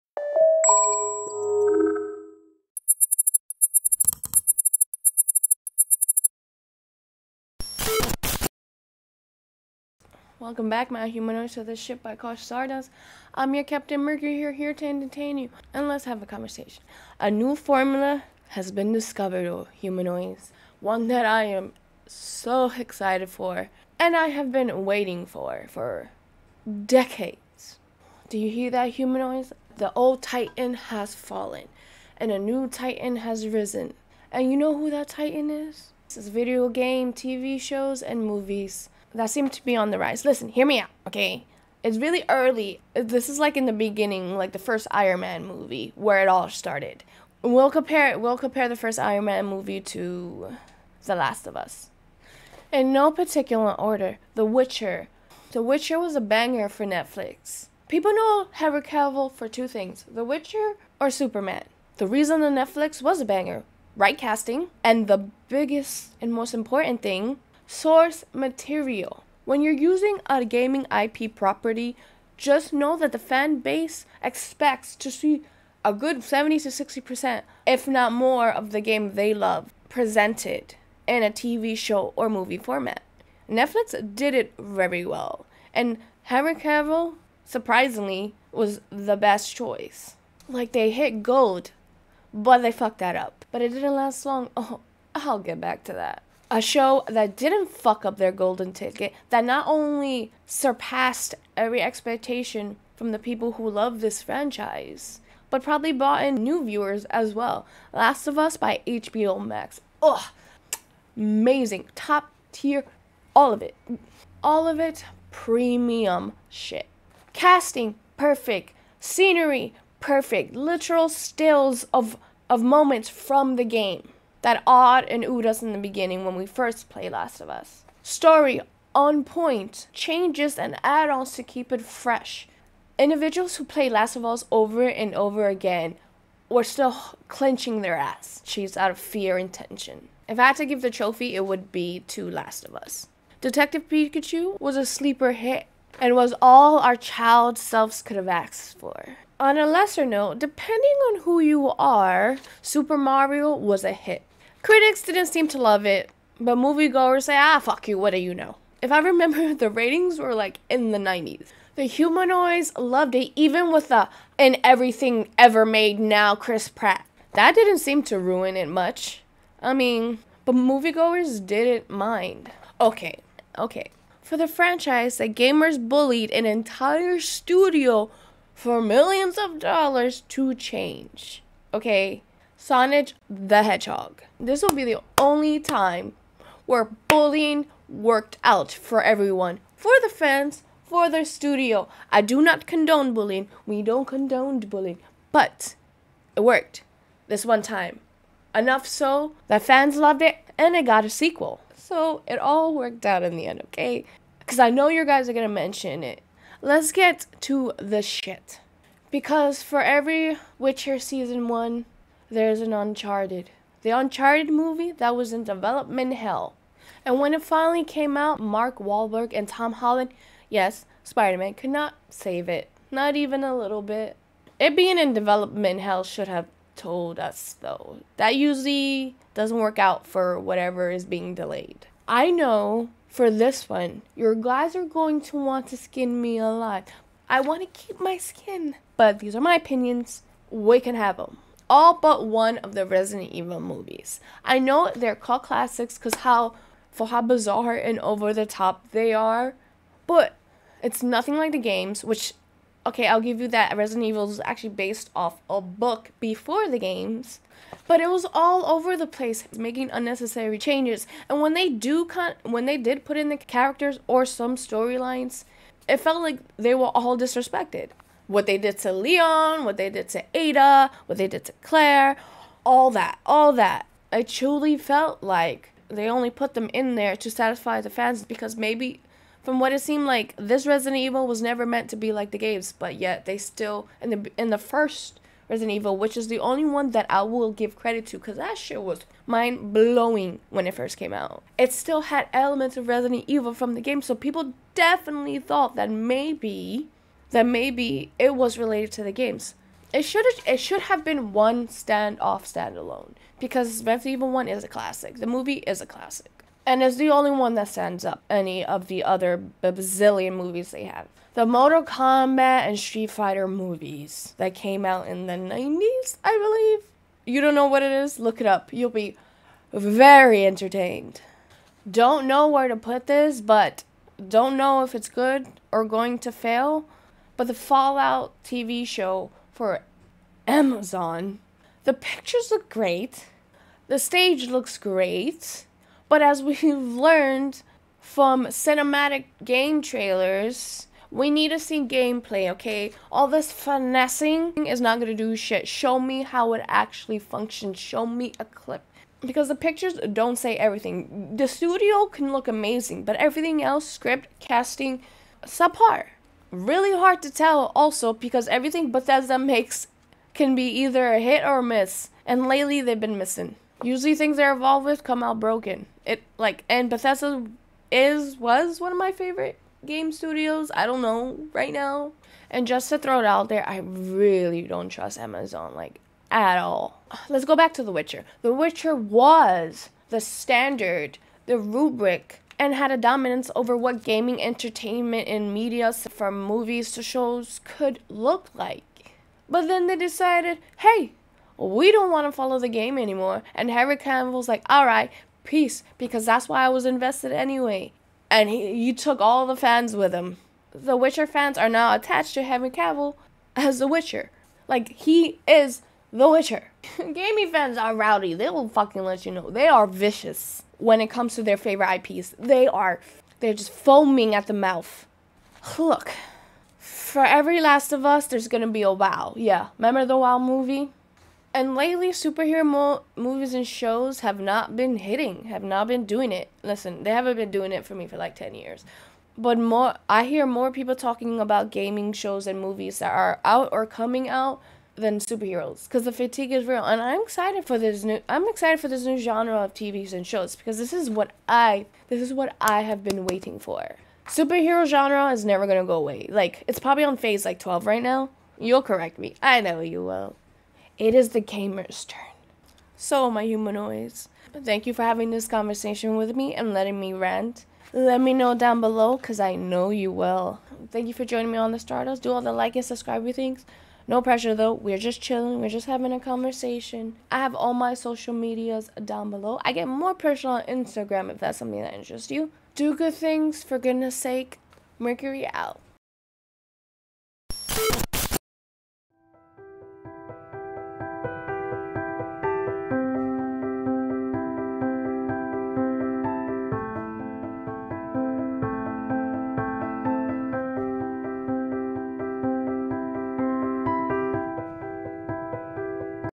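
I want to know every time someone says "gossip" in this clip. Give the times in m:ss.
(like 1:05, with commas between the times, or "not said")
not said.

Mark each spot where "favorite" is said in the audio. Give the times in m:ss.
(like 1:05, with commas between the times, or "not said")
6:09, 6:51.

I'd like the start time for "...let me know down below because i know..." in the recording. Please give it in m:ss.
7:37.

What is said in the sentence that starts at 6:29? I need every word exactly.
But then they decided, hey, we don't want to follow the game anymore.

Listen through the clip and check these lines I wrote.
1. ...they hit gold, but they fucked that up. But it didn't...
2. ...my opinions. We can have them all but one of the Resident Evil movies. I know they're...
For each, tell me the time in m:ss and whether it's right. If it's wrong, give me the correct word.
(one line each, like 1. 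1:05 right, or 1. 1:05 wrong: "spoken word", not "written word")
1. 1:30 right
2. 3:59 right.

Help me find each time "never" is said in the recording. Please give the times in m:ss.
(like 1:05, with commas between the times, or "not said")
4:41, 7:25.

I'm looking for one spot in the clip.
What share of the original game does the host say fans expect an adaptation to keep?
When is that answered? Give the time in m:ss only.
1:16.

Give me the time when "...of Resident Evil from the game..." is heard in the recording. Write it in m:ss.
4:52.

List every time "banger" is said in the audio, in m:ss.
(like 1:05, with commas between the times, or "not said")
0:56, 1:03.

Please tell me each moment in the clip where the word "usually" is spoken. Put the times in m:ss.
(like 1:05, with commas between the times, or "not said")
3:48, 6:03.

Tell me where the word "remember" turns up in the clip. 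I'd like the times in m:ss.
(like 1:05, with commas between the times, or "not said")
2:38, 6:59.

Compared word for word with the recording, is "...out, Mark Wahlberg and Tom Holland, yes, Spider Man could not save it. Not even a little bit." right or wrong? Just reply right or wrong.
right.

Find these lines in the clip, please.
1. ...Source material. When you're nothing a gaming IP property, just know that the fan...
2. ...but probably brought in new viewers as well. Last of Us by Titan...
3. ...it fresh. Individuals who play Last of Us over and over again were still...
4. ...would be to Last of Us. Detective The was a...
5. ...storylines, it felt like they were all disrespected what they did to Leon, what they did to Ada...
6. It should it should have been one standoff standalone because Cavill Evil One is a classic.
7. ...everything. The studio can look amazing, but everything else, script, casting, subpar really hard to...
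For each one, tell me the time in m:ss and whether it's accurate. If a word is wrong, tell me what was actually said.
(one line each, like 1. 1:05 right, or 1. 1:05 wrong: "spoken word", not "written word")
1. 1:07 wrong: "using", not "nothing"
2. 1:45 wrong: "HBO", not "Titan"
3. 2:11 right
4. 2:21 wrong: "Pikachu", not "The"
5. 4:24 right
6. 4:59 wrong: "Resident", not "Cavill"
7. 5:50 right.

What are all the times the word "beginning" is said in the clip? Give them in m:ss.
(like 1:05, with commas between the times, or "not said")
0:43, 2:05.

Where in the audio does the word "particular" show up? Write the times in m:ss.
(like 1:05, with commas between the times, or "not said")
0:53.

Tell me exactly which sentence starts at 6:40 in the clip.
The Witcher fans are now attached to Henry Cavill as The Witcher.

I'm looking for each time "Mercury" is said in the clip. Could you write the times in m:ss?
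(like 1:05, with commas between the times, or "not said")
0:14, 7:54.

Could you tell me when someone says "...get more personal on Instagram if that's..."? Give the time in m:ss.
7:49.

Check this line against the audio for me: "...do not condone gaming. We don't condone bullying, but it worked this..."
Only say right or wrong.
wrong.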